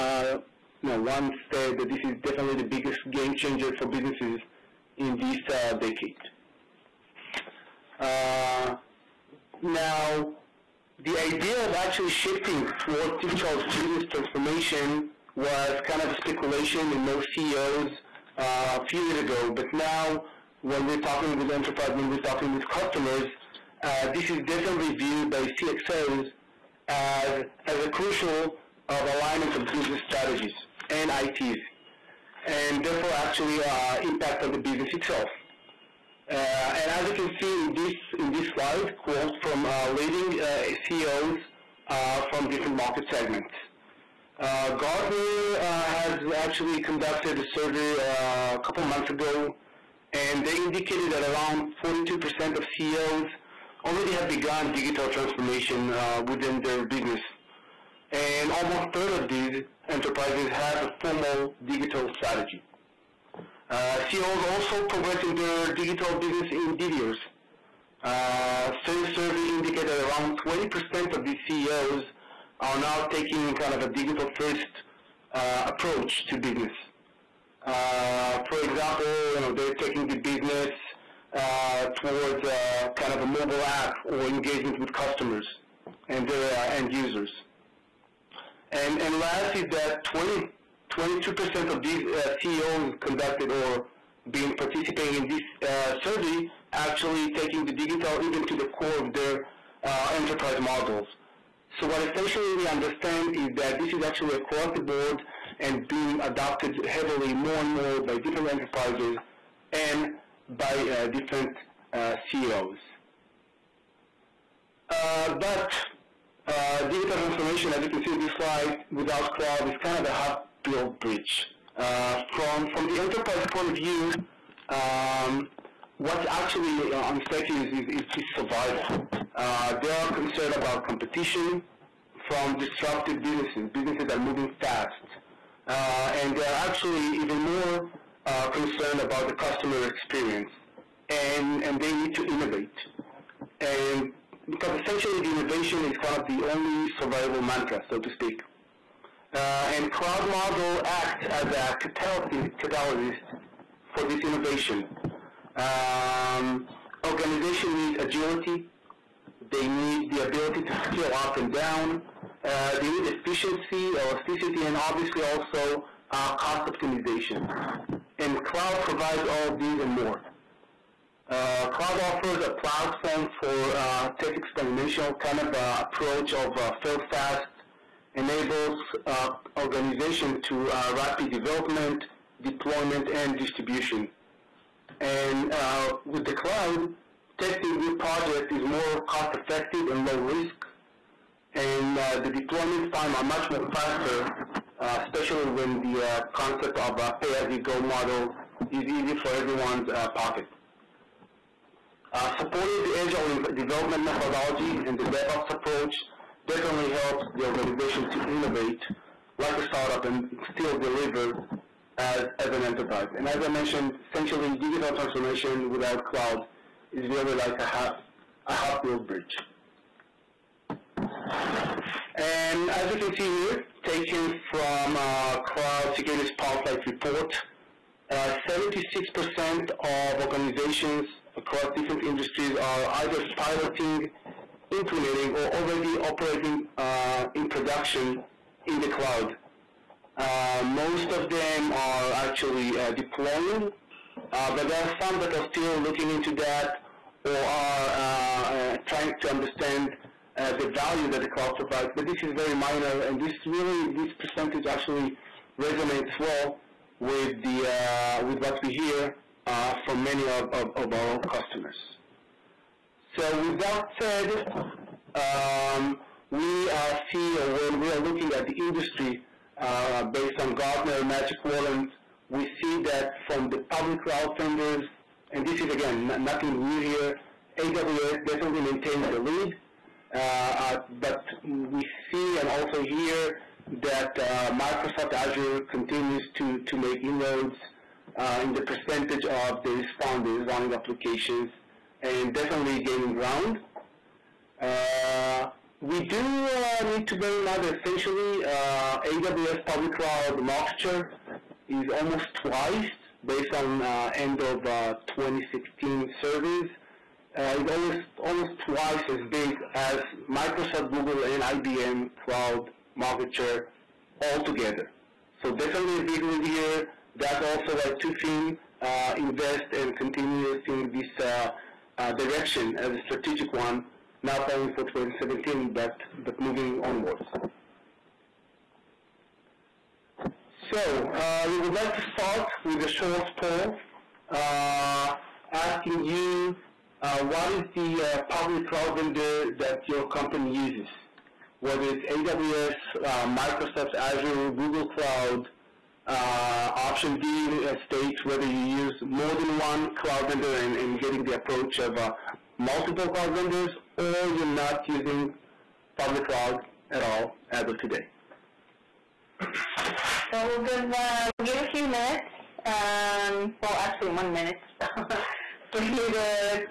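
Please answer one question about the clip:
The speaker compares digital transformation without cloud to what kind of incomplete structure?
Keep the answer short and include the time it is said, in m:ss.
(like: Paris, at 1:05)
A half built bridge, at 2:00.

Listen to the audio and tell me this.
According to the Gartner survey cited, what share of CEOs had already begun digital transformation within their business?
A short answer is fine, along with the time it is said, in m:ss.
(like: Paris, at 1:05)
42%, at 0:51.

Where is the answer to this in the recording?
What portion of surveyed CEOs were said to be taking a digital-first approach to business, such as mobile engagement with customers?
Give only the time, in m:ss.
1:10.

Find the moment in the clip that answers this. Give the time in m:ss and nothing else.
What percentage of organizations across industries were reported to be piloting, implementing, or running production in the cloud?
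3:48.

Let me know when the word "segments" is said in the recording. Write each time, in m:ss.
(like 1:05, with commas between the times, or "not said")
0:43.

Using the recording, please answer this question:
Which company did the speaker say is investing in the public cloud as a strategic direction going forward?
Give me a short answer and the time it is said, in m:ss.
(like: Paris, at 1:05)
Tufin, at 5:18.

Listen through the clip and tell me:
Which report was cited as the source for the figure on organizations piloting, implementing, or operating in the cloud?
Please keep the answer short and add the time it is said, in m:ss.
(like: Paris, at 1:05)
Cloud Security Spotlight report, at 3:45.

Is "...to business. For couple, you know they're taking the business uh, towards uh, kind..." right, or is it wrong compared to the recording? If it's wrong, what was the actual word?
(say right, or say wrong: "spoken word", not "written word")
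wrong: "example", not "couple".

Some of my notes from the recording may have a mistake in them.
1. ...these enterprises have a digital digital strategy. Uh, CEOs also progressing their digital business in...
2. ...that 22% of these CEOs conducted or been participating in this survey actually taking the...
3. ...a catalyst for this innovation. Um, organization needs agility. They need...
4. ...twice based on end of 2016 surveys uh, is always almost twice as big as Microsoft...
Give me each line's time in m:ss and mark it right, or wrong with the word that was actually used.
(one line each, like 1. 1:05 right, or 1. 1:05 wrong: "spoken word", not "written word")
1. 0:59 wrong: "formal", not "digital"
2. 1:29 right
3. 2:31 right
4. 5:02 right.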